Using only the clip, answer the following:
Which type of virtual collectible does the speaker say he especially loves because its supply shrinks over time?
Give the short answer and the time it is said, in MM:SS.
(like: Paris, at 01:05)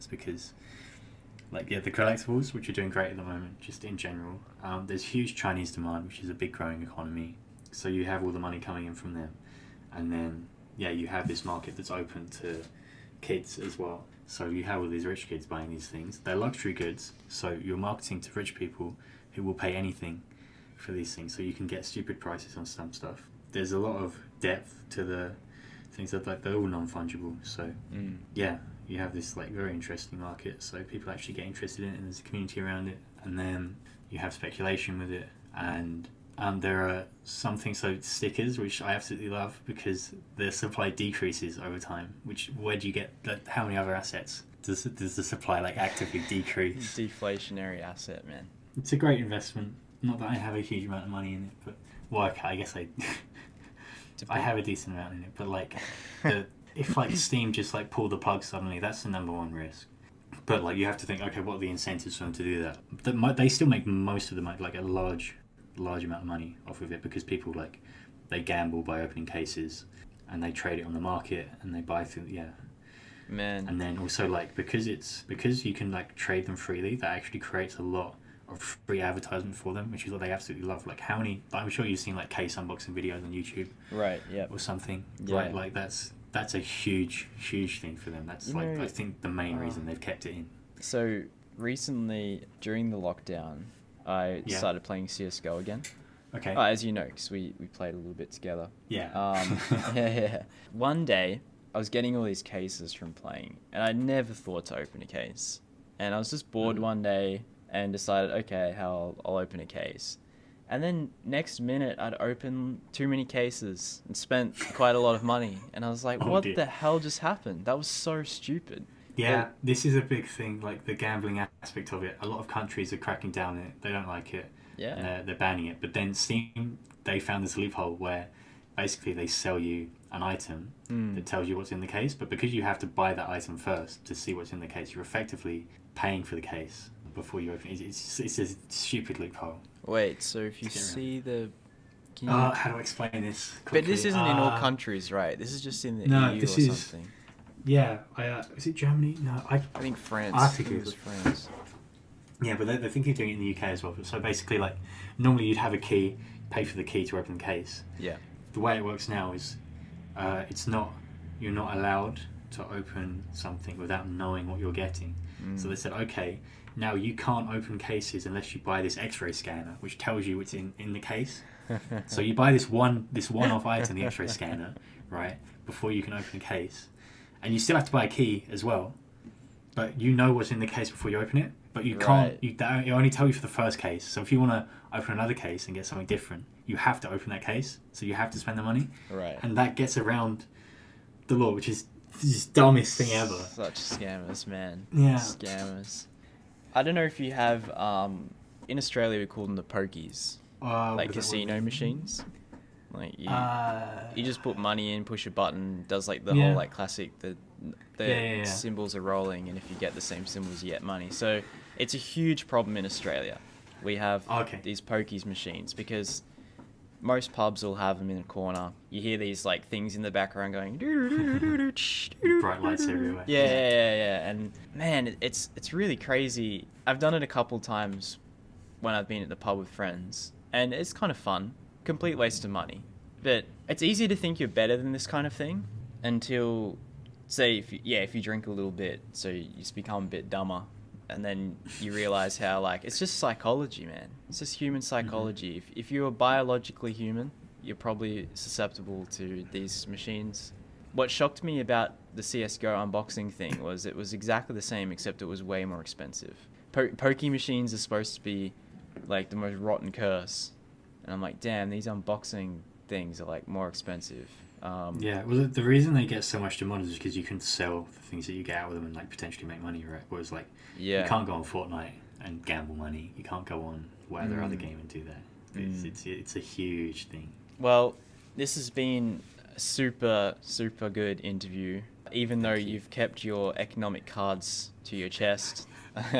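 Stickers, at 00:38.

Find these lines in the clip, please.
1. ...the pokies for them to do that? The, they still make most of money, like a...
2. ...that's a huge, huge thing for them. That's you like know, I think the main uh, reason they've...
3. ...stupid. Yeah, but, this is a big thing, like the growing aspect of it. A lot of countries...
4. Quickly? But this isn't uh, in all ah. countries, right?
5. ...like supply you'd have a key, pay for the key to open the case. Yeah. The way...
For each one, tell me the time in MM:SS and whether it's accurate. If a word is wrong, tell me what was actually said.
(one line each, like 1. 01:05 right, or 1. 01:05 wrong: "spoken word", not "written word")
1. 01:01 wrong: "incentives", not "pokies"
2. 01:26 right
3. 01:58 wrong: "gambling", not "growing"
4. 02:23 right
5. 02:34 wrong: "normally", not "supply".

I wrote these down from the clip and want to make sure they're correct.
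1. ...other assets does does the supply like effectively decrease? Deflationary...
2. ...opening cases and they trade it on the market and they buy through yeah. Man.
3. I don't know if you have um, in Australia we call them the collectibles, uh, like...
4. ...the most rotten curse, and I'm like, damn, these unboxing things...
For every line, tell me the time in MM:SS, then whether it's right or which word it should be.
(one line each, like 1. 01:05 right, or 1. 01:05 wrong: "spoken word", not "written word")
1. 00:43 wrong: "actively", not "effectively"
2. 01:09 right
3. 03:16 wrong: "pokies", not "collectibles"
4. 04:19 right.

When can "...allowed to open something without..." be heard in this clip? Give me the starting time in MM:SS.
02:41.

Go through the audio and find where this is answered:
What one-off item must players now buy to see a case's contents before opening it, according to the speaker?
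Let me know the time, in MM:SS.
02:48.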